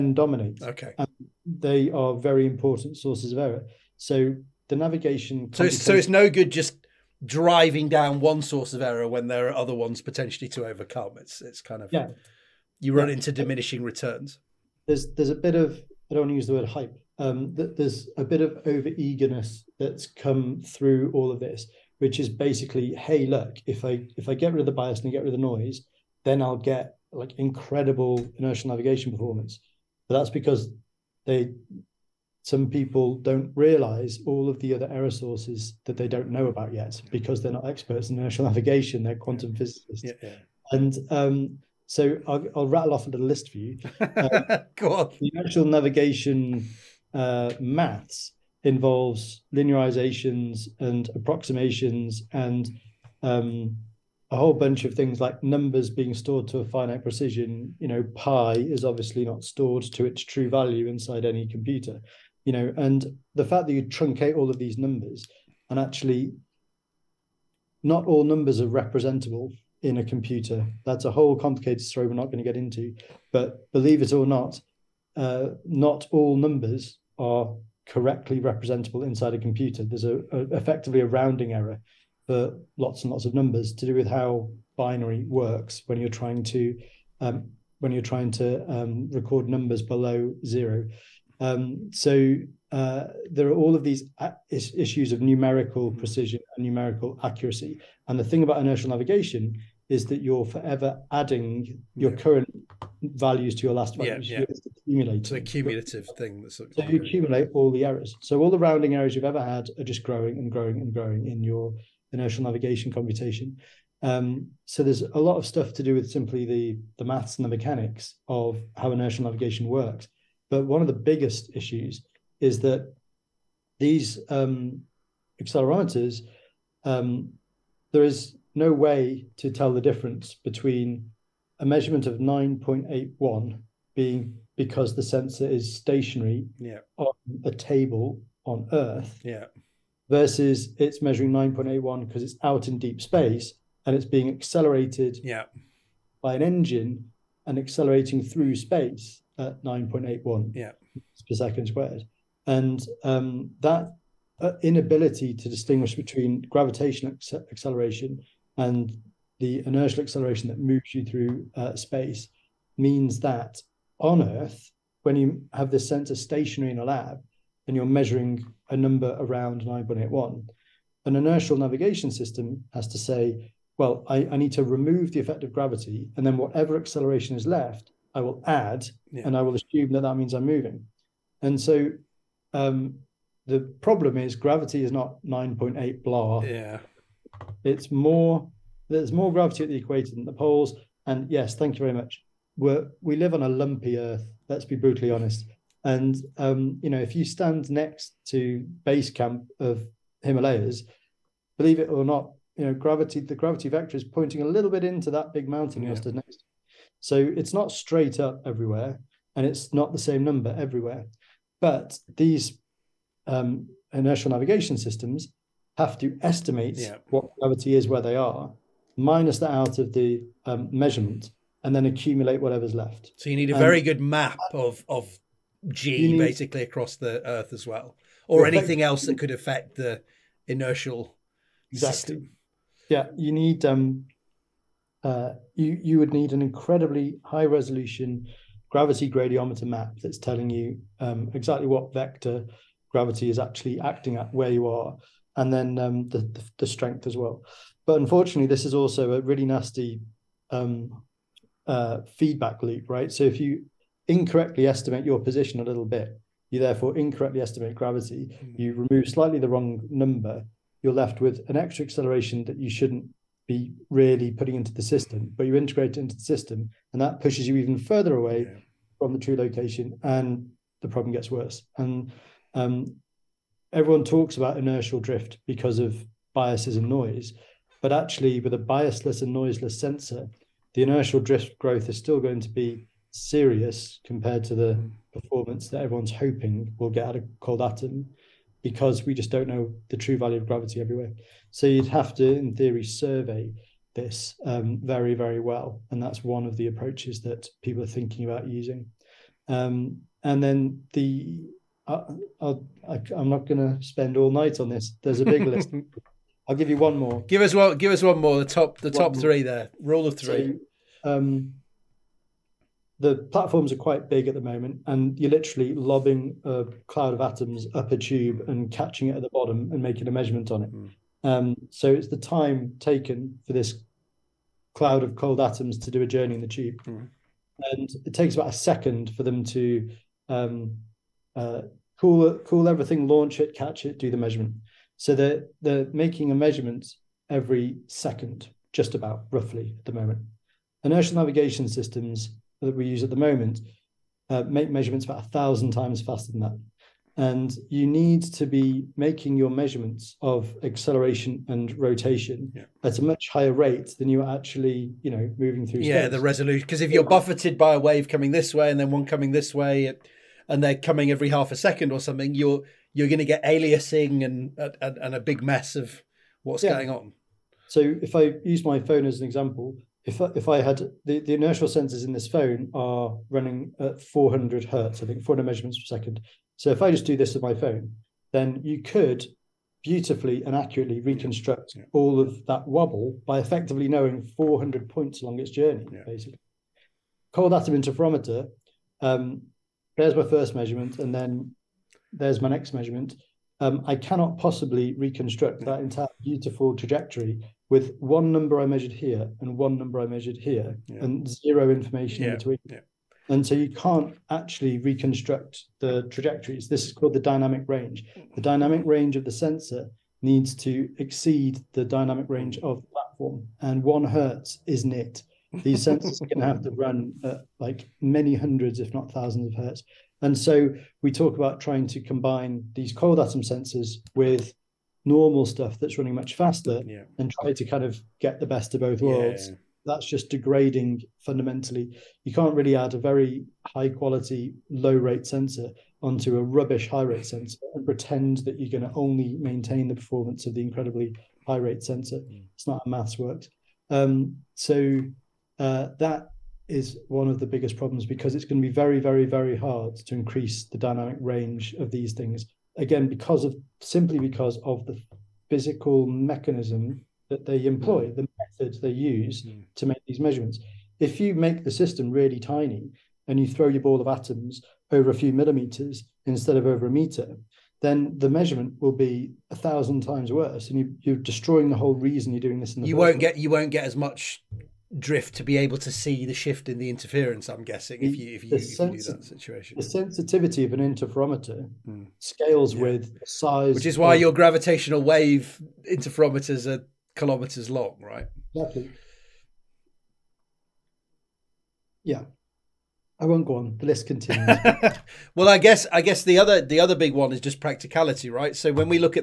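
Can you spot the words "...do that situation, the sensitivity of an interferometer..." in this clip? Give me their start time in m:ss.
7:58.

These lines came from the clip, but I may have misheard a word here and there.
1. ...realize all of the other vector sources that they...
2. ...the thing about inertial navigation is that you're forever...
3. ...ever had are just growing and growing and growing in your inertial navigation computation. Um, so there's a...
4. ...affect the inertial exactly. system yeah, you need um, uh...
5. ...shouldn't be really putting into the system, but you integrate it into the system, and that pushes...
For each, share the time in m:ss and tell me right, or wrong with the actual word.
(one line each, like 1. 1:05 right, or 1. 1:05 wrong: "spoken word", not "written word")
1. 0:33 wrong: "error", not "vector"
2. 1:38 right
3. 1:49 right
4. 3:49 right
5. 4:22 right.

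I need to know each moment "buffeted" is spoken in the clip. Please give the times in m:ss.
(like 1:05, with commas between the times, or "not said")
5:57.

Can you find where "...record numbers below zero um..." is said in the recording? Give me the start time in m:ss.
1:29.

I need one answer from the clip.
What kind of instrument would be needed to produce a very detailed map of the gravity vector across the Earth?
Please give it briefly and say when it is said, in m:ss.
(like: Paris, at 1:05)
Gravity gradiometer, at 3:58.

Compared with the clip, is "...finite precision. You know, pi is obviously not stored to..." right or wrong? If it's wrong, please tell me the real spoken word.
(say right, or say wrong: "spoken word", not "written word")
right.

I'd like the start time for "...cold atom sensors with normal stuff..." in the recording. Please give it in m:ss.
7:02.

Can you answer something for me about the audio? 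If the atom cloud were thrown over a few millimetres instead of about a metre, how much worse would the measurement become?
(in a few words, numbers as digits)
1000 times worse.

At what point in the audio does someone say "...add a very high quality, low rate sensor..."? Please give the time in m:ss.
7:12.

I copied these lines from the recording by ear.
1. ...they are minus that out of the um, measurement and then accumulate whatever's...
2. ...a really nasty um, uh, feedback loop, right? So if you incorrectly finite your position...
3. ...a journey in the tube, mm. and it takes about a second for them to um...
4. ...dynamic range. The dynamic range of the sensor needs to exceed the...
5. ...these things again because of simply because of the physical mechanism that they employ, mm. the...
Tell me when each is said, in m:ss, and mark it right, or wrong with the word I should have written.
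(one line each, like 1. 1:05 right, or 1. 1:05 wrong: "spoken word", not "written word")
1. 3:38 right
2. 4:09 wrong: "estimate", not "finite"
3. 5:26 right
4. 6:47 right
5. 7:31 right.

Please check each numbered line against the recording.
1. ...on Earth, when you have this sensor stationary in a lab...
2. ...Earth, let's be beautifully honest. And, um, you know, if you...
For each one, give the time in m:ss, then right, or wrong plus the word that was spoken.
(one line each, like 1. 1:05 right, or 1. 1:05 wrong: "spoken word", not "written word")
1. 2:43 right
2. 3:13 wrong: "brutally", not "beautifully".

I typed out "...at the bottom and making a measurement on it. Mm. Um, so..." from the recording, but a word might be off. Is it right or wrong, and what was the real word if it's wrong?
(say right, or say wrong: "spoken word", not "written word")
right.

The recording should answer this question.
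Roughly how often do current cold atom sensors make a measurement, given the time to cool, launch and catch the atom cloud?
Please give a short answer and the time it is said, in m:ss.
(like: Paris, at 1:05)
Every second, at 5:37.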